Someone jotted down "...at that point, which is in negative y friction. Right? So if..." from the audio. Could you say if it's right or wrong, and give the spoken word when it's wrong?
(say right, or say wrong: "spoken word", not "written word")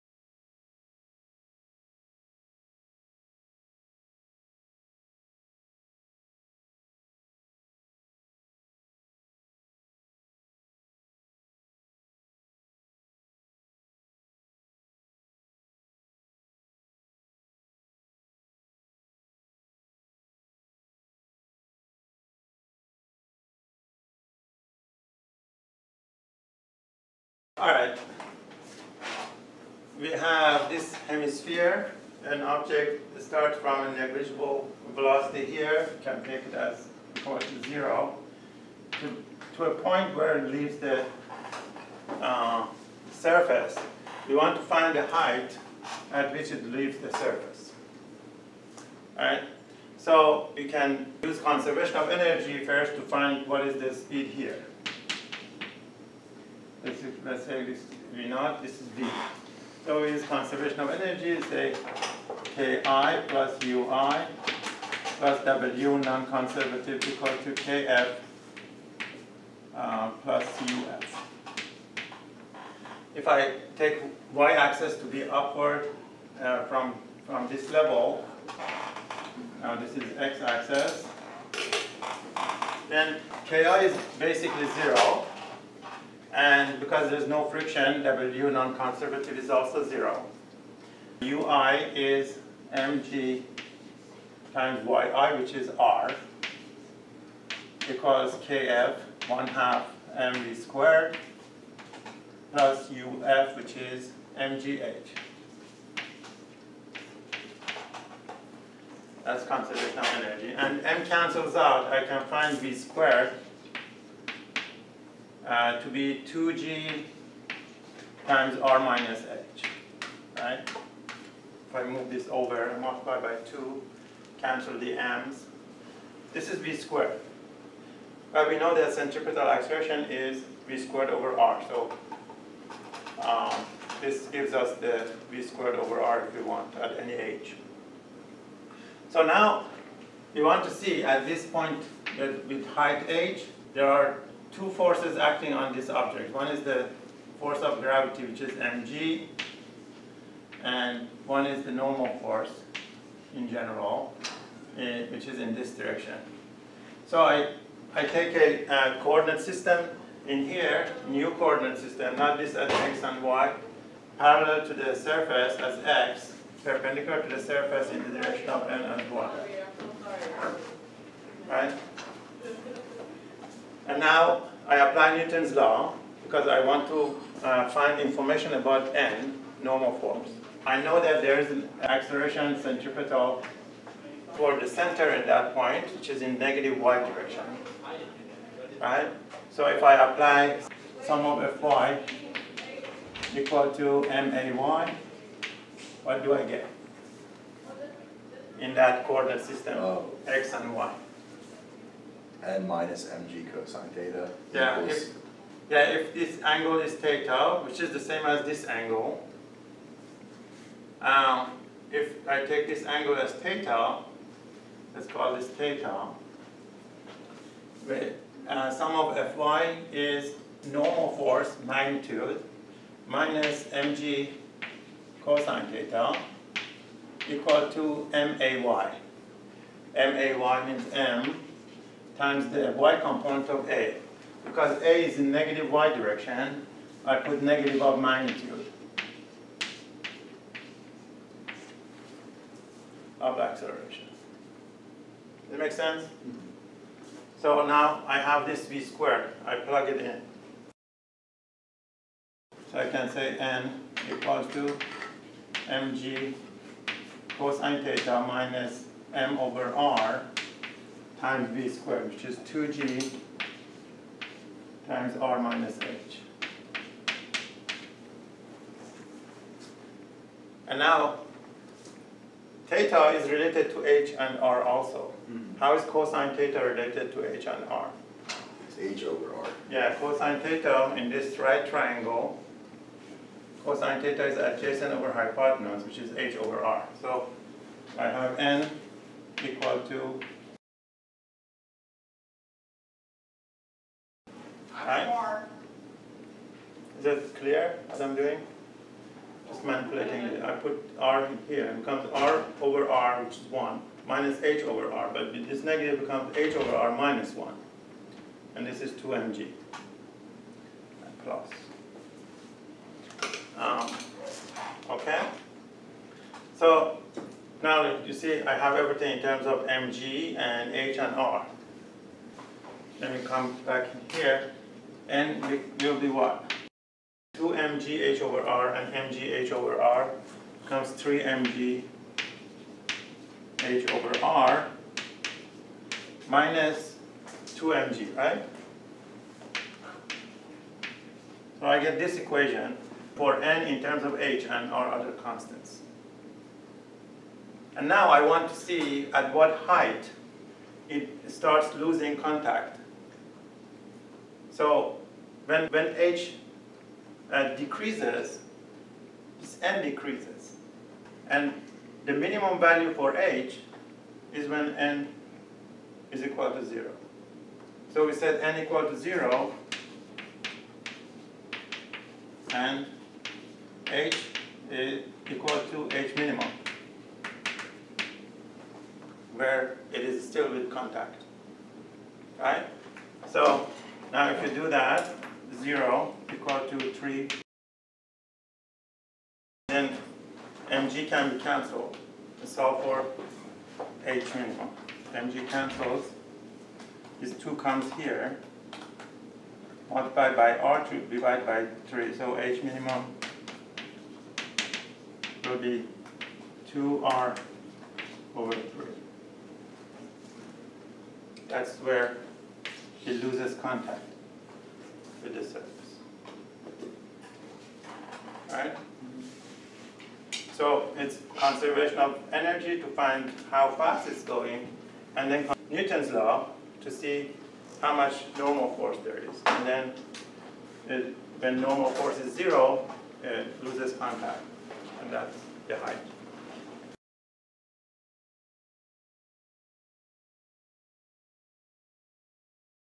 wrong: "direction", not "friction".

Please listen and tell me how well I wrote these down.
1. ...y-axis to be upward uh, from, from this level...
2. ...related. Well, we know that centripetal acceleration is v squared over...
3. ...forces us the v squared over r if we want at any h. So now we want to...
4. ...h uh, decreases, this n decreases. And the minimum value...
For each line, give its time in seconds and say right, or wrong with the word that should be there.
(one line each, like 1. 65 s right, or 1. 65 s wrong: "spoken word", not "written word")
1. 74 s right
2. 126 s wrong: "squared", not "related"
3. 134 s wrong: "gives", not "forces"
4. 355 s right.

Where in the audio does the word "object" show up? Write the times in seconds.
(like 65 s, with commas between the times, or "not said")
32 s, 145 s.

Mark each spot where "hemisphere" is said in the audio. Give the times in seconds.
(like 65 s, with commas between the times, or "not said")
31 s.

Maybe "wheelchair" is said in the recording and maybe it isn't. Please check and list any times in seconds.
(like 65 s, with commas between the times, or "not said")
not said.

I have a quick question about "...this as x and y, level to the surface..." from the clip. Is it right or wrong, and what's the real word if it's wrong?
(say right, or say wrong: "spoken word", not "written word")
wrong: "parallel", not "level".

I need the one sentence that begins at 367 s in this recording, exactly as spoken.
So we set n equal to 0 and h is equal to h minimum where it is still with contact.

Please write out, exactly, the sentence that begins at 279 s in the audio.
Yeah, cosine theta in this right triangle, cosine theta is adjacent over hypotenuse, which is h over r.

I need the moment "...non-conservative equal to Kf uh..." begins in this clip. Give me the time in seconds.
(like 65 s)
65 s.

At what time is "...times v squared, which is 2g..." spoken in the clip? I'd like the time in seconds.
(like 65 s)
261 s.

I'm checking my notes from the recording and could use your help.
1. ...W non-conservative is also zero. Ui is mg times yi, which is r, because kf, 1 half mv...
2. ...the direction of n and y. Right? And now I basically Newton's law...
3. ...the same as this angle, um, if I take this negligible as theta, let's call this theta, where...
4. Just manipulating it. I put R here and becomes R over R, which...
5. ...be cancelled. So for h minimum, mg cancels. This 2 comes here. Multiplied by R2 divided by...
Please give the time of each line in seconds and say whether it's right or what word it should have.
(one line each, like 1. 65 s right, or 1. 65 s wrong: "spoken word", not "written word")
1. 88 s right
2. 168 s wrong: "apply", not "basically"
3. 207 s wrong: "angle", not "negligible"
4. 299 s right
5. 391 s right.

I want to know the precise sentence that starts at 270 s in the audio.
And now, theta is related to h and r also.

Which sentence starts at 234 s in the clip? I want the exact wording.
Because A is in negative y direction, I put negative of magnitude of acceleration.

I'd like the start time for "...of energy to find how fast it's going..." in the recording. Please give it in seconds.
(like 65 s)
421 s.